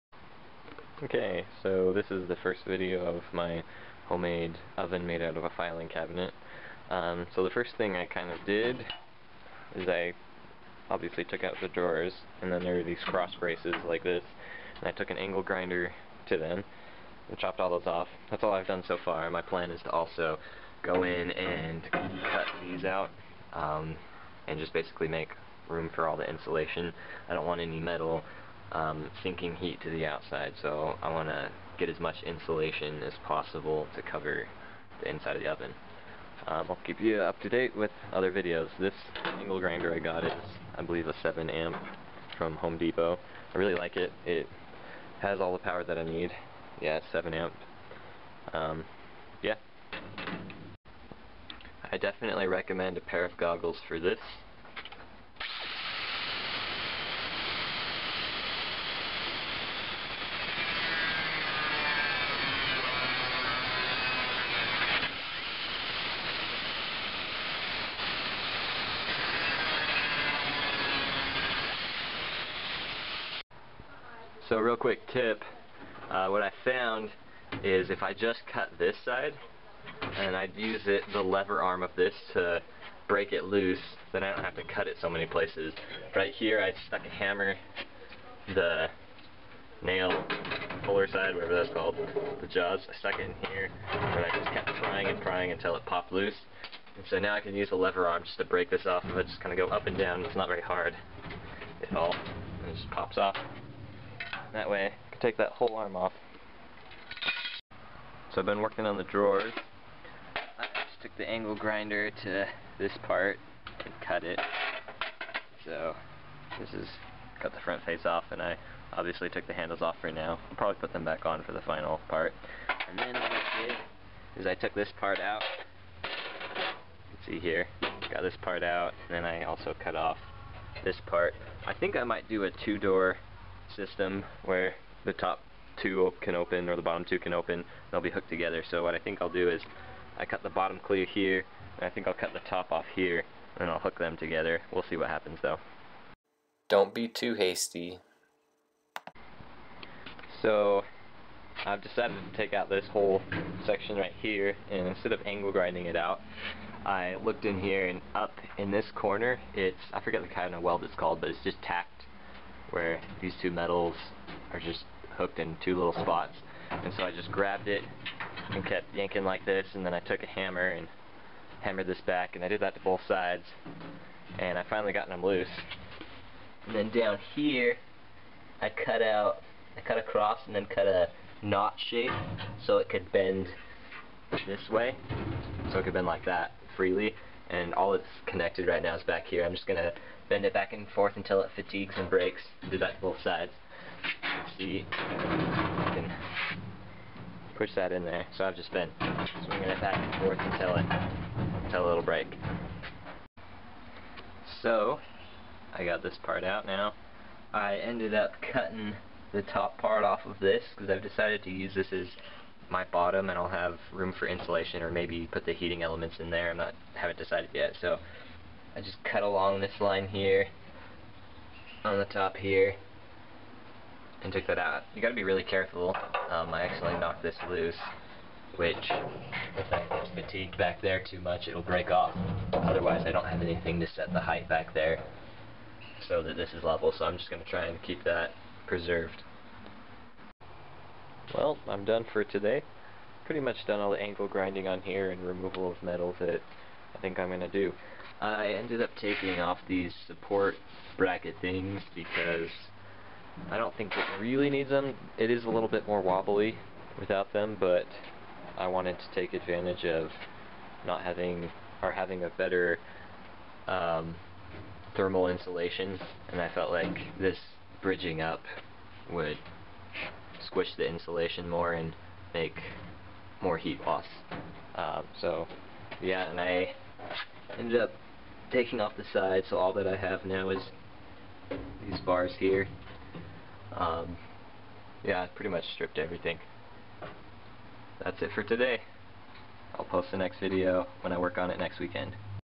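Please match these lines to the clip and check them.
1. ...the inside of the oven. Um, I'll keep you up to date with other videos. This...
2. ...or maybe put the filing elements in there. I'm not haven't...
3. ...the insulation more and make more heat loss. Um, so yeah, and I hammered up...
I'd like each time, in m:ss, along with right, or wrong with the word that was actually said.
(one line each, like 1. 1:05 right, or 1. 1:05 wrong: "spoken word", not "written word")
1. 0:35 right
2. 3:34 wrong: "heating", not "filing"
3. 4:30 wrong: "ended", not "hammered".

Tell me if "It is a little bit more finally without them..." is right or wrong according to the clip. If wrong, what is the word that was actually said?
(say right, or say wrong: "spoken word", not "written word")
wrong: "wobbly", not "finally".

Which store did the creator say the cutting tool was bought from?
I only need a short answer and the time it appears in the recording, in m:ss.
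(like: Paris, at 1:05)
Home Depot, at 0:42.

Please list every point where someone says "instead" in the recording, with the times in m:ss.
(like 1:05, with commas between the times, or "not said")
2:34.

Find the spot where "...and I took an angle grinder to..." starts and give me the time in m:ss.
0:14.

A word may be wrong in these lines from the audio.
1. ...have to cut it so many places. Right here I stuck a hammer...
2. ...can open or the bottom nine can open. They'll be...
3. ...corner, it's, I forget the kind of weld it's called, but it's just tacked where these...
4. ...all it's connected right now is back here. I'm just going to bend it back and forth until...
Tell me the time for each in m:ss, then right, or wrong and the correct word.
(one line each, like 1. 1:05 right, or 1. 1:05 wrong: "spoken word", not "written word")
1. 1:24 right
2. 2:16 wrong: "two", not "nine"
3. 2:38 right
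4. 3:07 right.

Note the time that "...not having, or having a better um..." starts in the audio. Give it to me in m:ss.
4:20.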